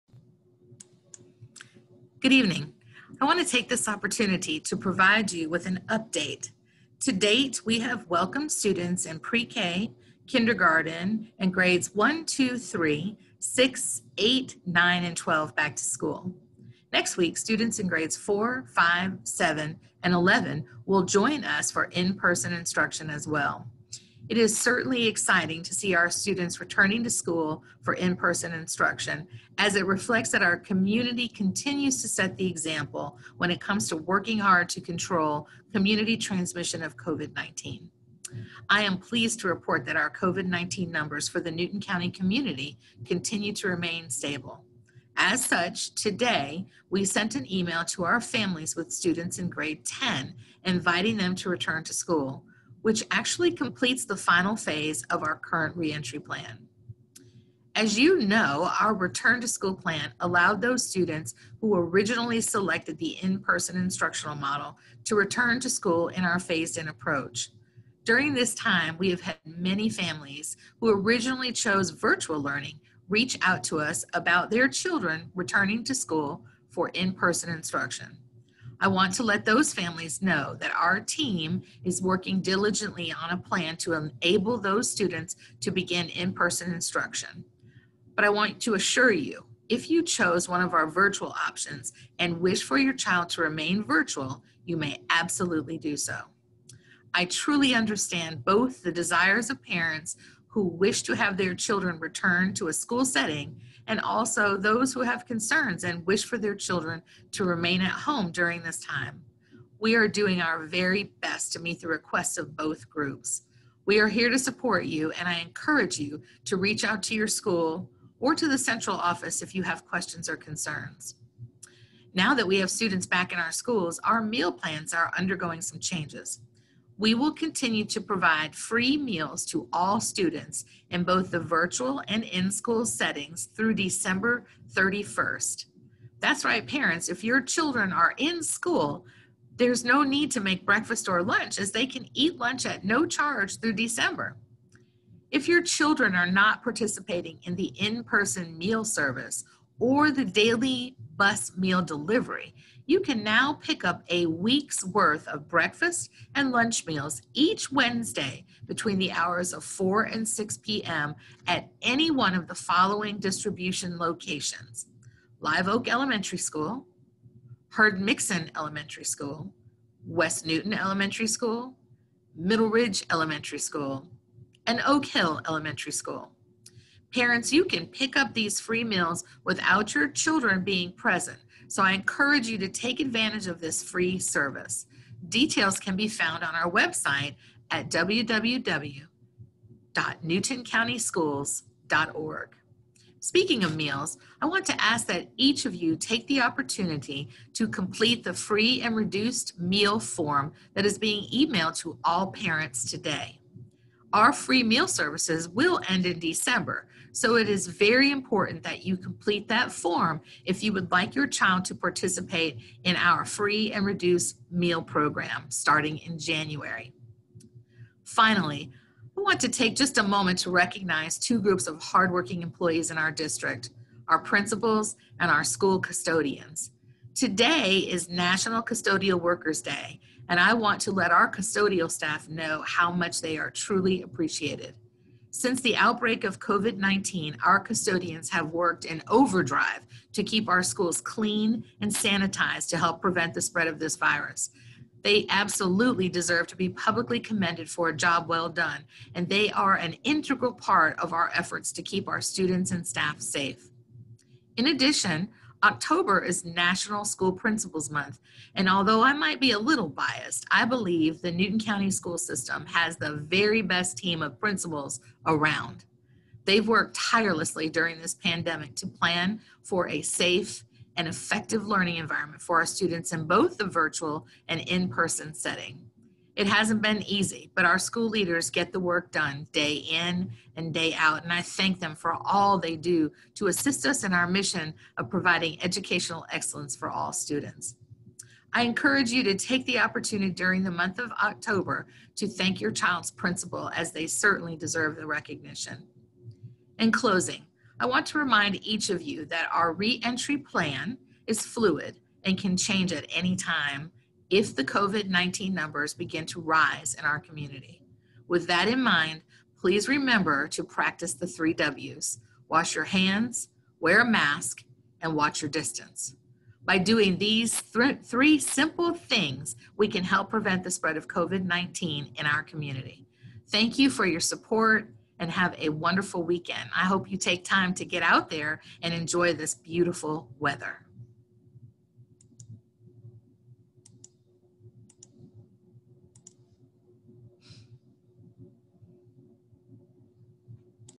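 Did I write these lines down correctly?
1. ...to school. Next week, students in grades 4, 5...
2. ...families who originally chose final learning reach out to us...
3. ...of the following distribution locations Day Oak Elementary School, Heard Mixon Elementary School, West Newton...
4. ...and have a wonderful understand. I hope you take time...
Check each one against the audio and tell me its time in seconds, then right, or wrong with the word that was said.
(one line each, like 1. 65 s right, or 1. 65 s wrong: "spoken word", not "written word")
1. 15 s right
2. 69 s wrong: "virtual", not "final"
3. 162 s wrong: "Live", not "Day"
4. 325 s wrong: "weekend", not "understand".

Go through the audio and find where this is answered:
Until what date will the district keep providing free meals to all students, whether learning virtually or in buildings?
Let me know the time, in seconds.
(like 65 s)
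133 s.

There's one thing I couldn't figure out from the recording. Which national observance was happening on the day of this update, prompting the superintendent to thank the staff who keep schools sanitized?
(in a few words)
National Custodial Workers Day.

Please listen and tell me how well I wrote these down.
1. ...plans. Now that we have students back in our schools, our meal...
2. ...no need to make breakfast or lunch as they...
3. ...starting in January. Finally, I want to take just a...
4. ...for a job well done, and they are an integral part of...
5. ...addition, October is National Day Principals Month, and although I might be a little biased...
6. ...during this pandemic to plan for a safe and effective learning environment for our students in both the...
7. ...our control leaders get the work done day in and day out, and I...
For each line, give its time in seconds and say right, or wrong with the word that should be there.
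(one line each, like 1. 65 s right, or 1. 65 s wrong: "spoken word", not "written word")
1. 120 s wrong: "concerns", not "plans"
2. 139 s right
3. 215 s right
4. 247 s right
5. 254 s wrong: "School", not "Day"
6. 267 s right
7. 277 s wrong: "school", not "control".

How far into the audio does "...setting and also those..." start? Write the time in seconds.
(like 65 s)
103 s.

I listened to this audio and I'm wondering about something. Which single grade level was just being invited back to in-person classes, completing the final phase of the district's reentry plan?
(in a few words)
Grade 10.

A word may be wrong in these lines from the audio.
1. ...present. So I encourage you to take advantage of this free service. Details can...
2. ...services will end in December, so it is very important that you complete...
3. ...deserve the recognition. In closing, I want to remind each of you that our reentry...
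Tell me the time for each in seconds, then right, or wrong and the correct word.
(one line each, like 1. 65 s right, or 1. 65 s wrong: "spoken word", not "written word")
1. 180 s right
2. 204 s right
3. 294 s right.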